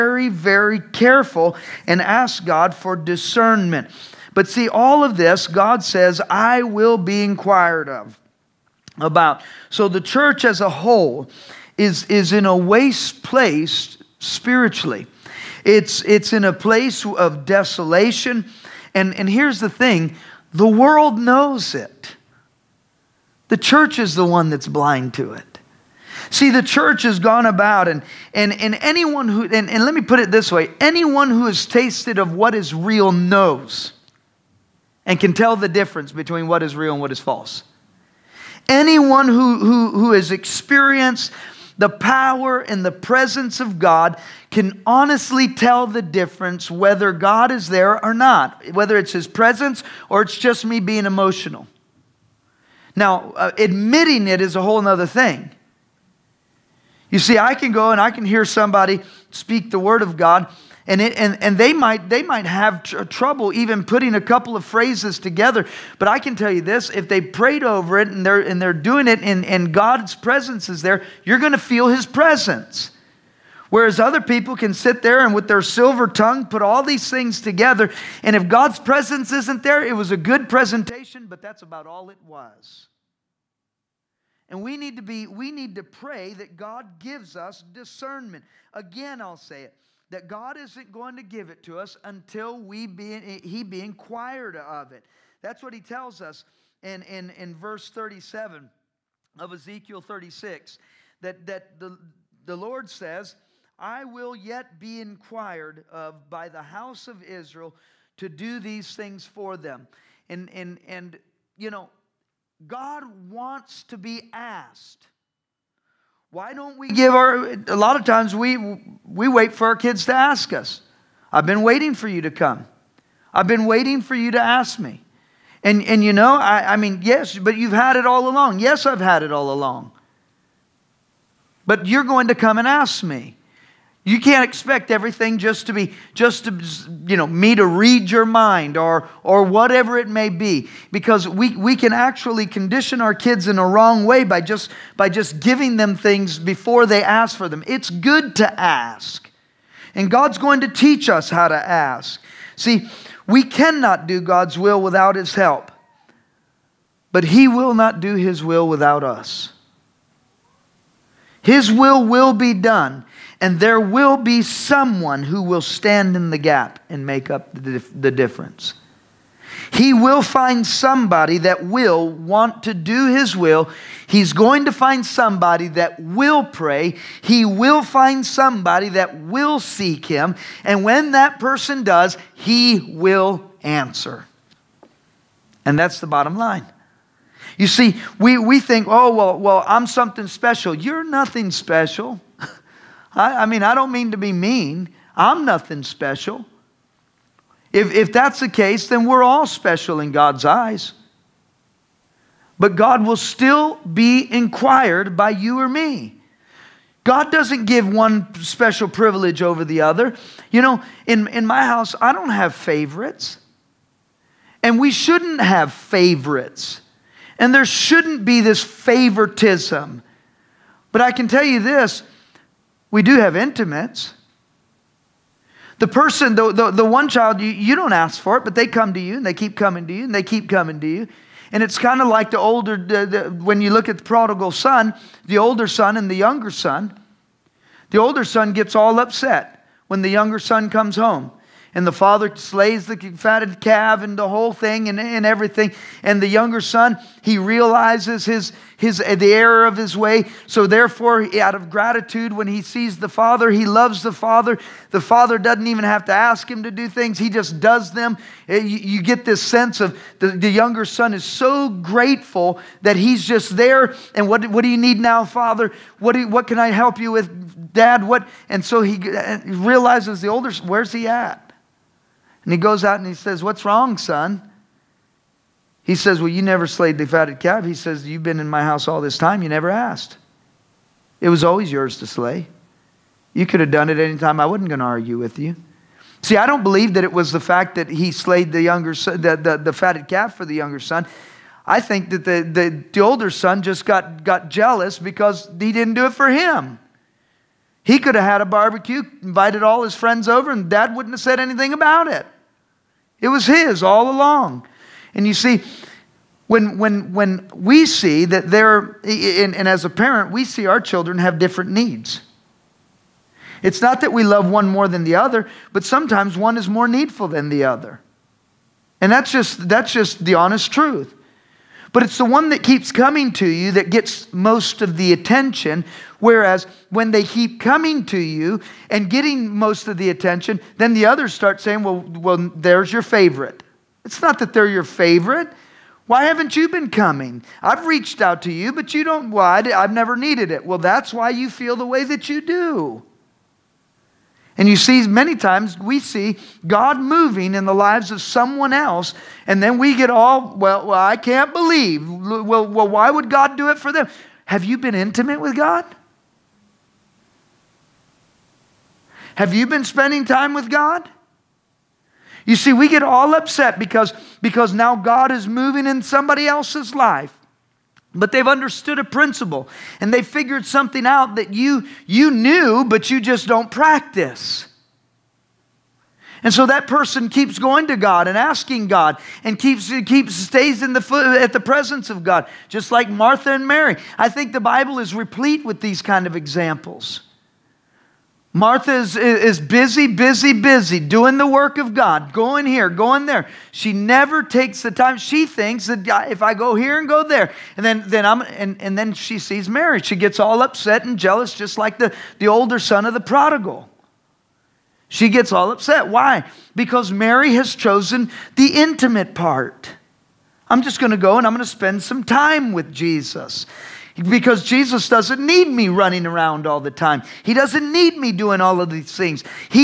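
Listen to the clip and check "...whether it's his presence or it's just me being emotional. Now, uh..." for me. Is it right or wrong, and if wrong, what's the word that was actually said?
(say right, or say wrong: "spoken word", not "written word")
right.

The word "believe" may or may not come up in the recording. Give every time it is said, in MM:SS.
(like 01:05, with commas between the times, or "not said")
04:46, 05:51.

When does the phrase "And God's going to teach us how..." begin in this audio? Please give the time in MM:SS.
02:29.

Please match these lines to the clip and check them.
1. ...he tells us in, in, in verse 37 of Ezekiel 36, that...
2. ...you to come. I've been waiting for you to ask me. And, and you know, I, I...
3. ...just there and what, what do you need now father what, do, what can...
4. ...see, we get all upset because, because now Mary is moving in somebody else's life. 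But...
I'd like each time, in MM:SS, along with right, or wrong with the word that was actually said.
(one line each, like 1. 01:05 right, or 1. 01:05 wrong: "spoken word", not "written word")
1. 01:35 right
2. 02:02 right
3. 04:23 right
4. 06:02 wrong: "God", not "Mary".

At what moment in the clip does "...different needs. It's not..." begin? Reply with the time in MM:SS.
05:11.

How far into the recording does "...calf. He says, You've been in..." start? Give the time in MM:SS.
04:37.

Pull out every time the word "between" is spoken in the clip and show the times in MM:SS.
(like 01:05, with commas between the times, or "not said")
00:36.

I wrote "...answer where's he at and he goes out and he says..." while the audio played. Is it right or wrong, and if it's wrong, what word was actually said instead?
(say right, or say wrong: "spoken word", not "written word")
wrong: "older", not "answer".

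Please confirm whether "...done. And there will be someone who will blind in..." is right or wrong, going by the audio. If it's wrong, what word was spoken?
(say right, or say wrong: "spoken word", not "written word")
wrong: "stand", not "blind".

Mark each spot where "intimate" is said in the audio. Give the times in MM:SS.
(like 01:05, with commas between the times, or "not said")
03:43, 05:54, 06:48.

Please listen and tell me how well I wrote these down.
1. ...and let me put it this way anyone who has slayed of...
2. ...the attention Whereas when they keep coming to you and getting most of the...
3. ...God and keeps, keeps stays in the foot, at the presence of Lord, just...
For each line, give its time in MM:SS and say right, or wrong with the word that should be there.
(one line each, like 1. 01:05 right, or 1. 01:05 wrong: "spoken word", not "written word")
1. 00:29 wrong: "tasted", not "slayed"
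2. 05:24 right
3. 06:18 wrong: "God", not "Lord".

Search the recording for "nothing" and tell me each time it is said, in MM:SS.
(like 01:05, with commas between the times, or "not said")
03:11, 03:15.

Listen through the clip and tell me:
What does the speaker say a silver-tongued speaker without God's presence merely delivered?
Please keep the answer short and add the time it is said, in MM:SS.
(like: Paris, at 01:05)
a good presentation, at 01:20.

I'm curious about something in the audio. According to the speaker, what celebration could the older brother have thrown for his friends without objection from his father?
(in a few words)
a barbecue.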